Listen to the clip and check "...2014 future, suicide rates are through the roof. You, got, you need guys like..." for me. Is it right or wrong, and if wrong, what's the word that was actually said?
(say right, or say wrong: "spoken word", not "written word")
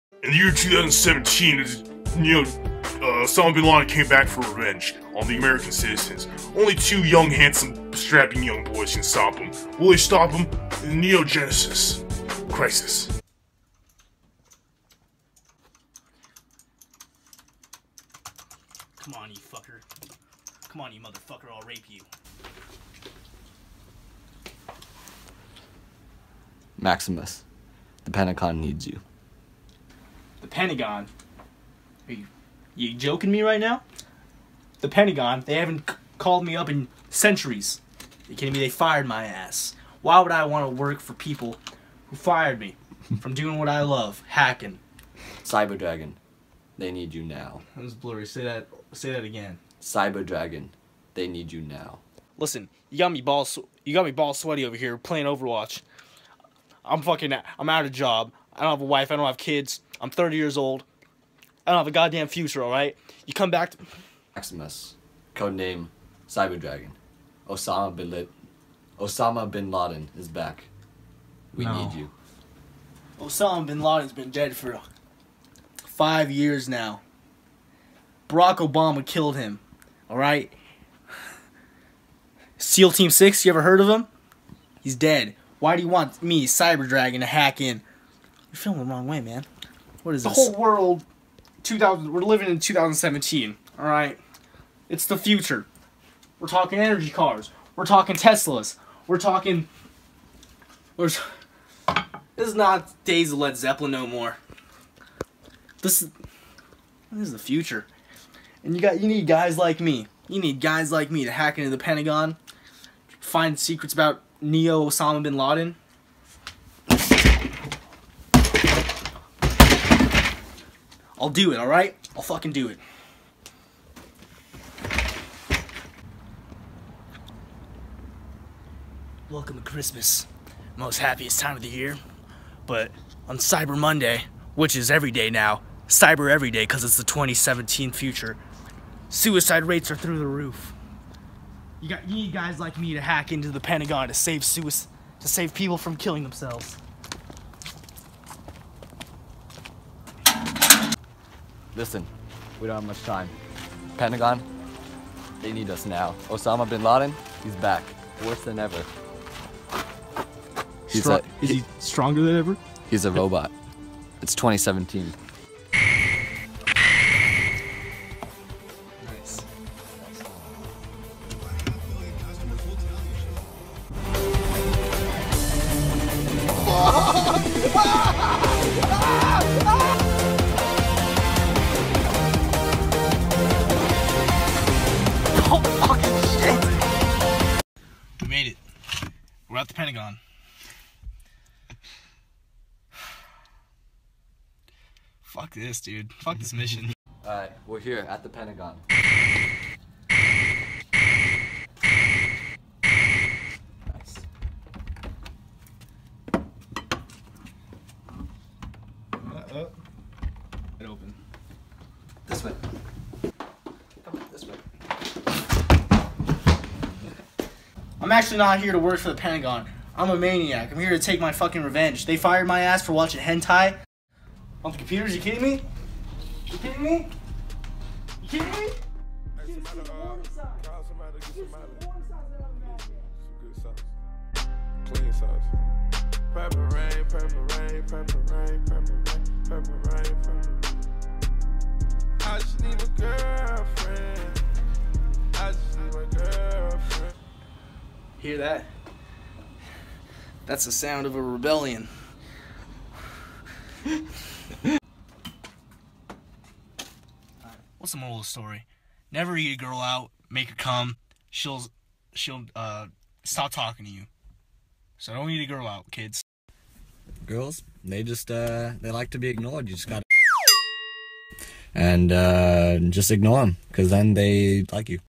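wrong: "2017", not "2014".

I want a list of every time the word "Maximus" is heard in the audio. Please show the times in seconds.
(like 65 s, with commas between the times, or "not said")
26 s, 64 s.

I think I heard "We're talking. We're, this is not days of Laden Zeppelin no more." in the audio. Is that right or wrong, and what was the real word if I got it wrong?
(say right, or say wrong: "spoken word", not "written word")
wrong: "Led", not "Laden".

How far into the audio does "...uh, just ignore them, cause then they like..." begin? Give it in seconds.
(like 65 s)
272 s.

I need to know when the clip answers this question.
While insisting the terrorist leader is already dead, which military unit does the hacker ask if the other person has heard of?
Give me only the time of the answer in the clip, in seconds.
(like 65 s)
82 s.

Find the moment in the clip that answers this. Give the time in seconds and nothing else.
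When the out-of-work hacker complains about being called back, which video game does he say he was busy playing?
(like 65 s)
55 s.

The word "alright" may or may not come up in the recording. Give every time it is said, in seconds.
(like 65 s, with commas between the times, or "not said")
62 s, 80 s, 121 s, 197 s.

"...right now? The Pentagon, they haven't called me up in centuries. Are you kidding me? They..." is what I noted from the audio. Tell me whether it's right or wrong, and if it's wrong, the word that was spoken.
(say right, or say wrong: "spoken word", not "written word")
right.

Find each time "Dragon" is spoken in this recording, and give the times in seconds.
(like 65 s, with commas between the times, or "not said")
45 s, 50 s, 66 s, 86 s.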